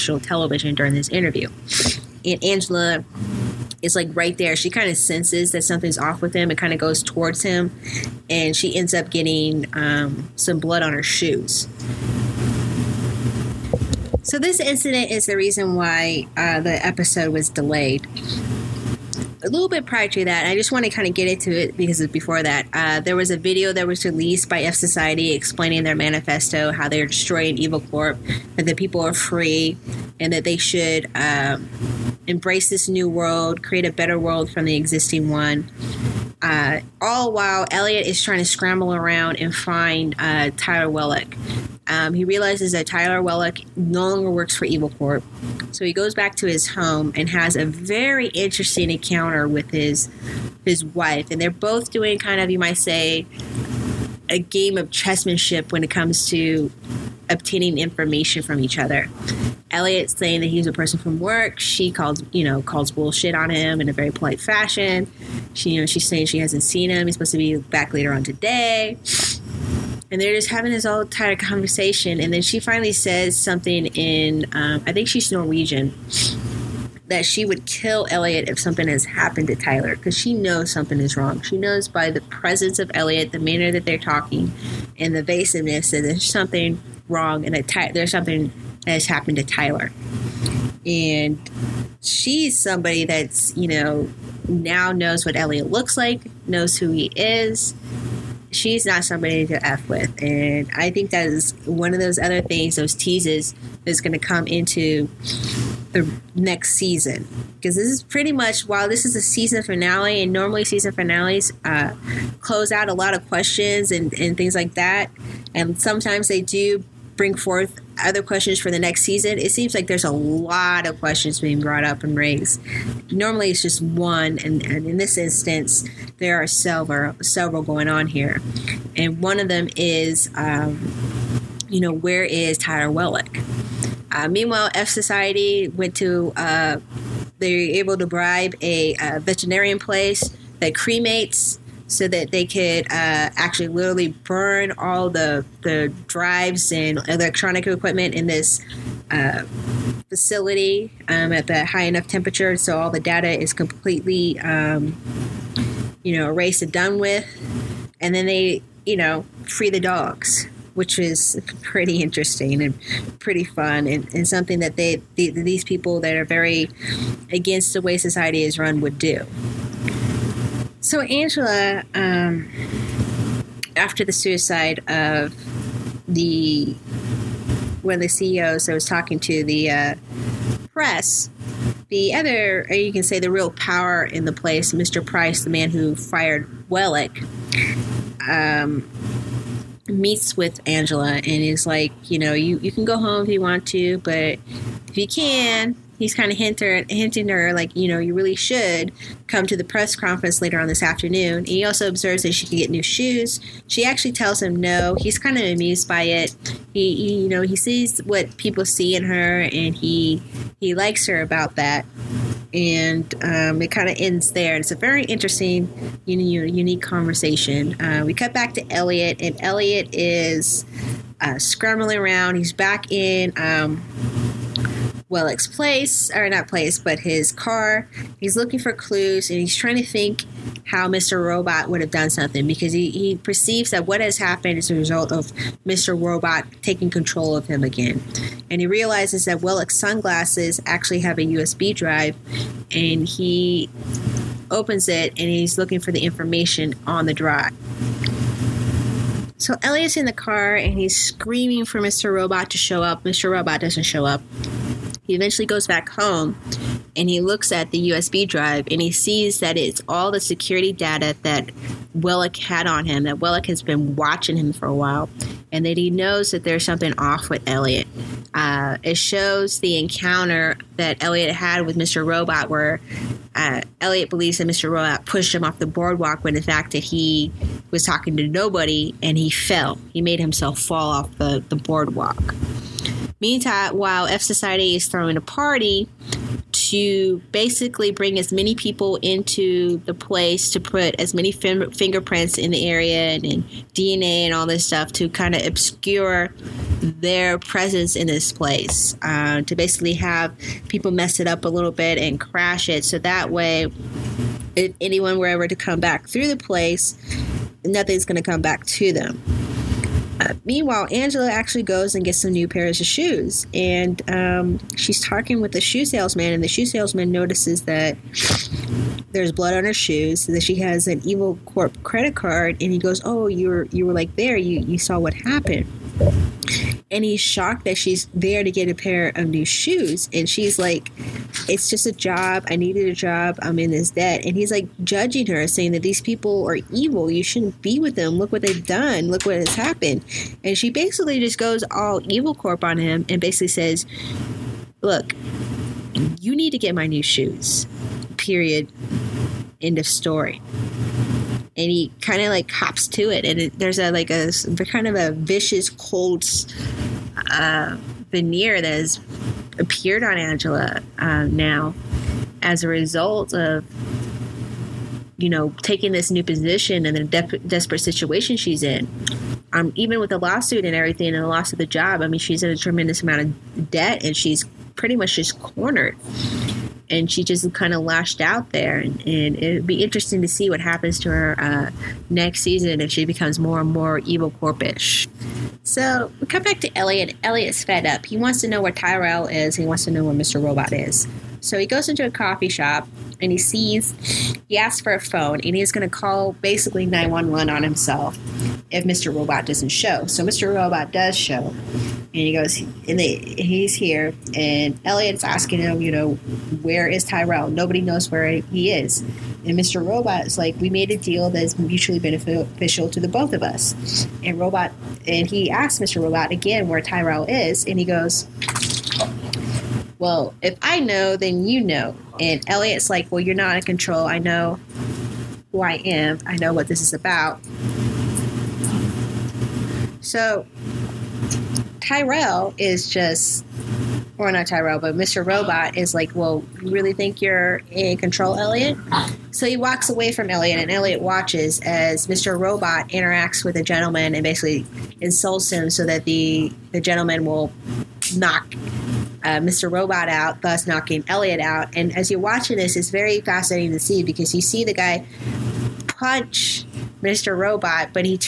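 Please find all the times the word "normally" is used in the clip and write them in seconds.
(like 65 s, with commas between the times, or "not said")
110 s, 123 s.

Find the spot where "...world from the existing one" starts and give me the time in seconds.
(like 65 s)
34 s.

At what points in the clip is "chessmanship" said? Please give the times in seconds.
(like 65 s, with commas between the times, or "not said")
54 s.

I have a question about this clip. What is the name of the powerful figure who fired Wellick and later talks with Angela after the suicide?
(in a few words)
Mr. Price.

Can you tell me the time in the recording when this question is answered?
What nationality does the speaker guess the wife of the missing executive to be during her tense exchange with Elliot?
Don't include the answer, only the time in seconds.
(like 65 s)
75 s.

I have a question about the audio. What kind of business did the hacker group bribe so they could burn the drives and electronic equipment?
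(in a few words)
A veterinarian place.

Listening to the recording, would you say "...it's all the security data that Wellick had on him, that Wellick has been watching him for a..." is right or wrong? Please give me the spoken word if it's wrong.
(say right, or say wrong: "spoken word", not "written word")
right.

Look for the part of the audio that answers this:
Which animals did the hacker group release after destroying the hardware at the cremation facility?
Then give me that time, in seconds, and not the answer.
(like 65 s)
159 s.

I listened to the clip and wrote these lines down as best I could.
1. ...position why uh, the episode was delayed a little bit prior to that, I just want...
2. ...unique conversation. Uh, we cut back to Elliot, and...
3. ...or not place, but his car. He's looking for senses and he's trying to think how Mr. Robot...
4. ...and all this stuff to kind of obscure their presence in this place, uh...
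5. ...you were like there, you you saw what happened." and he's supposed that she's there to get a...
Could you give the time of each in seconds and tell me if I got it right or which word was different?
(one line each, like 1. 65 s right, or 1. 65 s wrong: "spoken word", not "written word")
1. 15 s wrong: "reason", not "position"
2. 216 s right
3. 226 s wrong: "clues", not "senses"
4. 294 s right
5. 323 s wrong: "shocked", not "supposed".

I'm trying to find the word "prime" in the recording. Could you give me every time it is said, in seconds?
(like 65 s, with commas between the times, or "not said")
not said.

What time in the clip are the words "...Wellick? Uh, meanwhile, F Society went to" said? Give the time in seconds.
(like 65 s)
132 s.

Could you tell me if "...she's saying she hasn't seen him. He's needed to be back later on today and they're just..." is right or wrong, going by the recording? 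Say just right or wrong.
wrong.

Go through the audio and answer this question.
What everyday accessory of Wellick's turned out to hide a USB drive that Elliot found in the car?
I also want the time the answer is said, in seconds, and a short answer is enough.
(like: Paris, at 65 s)
Sunglasses, at 239 s.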